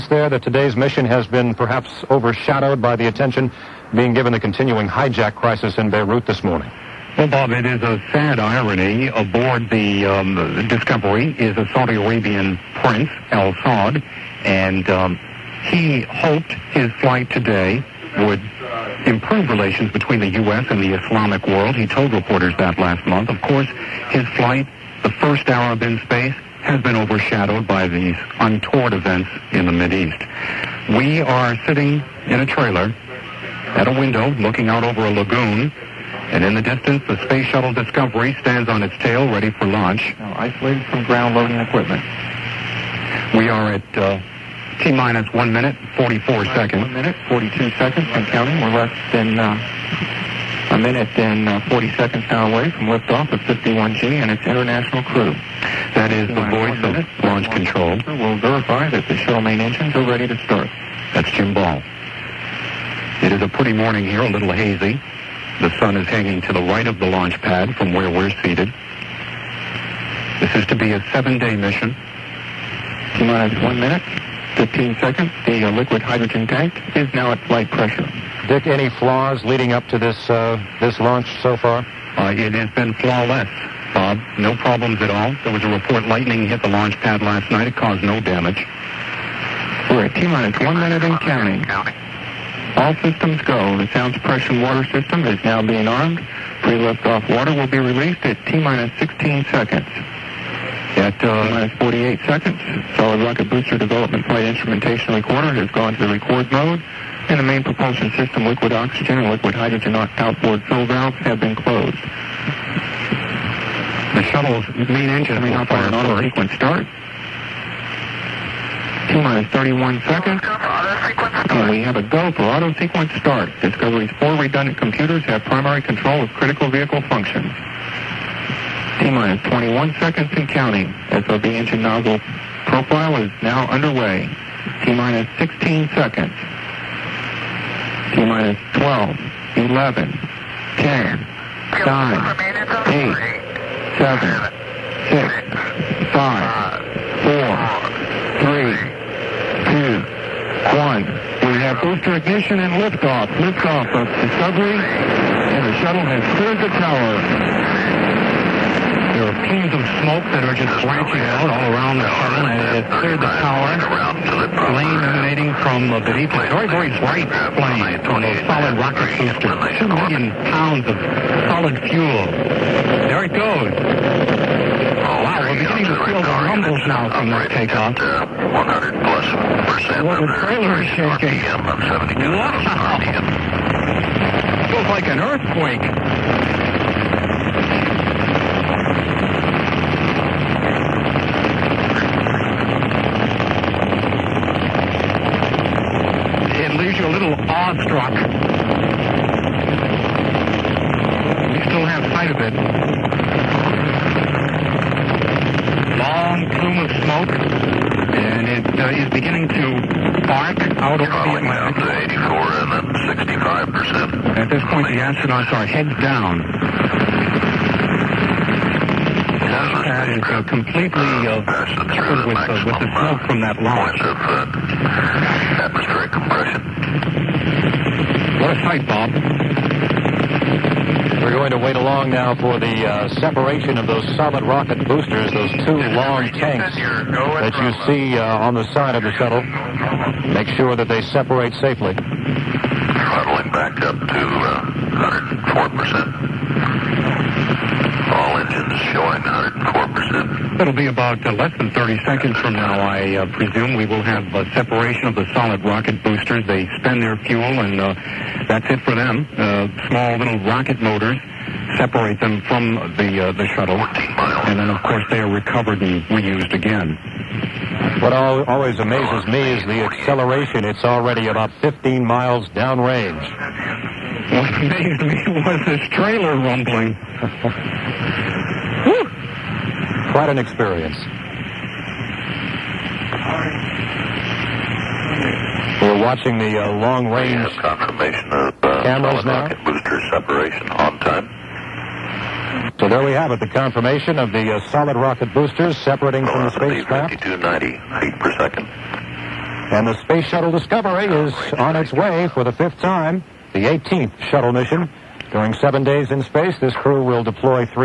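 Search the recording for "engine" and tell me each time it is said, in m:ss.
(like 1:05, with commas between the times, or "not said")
0:59, 1:55, 2:11.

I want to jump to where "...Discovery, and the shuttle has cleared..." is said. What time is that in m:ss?
2:34.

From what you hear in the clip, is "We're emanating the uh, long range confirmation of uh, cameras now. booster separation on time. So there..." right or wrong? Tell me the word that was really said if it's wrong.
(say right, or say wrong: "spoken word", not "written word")
wrong: "watching", not "emanating".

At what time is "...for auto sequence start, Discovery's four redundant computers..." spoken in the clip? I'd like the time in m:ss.
2:02.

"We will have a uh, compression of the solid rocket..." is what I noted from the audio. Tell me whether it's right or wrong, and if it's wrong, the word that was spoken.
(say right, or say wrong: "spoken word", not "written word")
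wrong: "separation", not "compression".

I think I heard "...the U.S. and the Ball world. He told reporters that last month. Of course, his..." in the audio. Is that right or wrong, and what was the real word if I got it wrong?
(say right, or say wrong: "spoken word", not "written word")
wrong: "Islamic", not "Ball".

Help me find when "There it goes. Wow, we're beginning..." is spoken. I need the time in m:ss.
2:53.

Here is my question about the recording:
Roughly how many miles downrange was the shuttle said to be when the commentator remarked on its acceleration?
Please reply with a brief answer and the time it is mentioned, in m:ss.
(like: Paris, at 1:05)
15 miles, at 4:31.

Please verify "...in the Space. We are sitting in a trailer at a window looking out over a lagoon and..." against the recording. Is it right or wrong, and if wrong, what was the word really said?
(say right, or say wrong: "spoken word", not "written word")
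wrong: "East", not "Space".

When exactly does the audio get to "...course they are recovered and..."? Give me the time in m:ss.
4:24.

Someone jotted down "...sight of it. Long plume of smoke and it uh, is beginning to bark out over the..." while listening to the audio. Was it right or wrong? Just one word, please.
right.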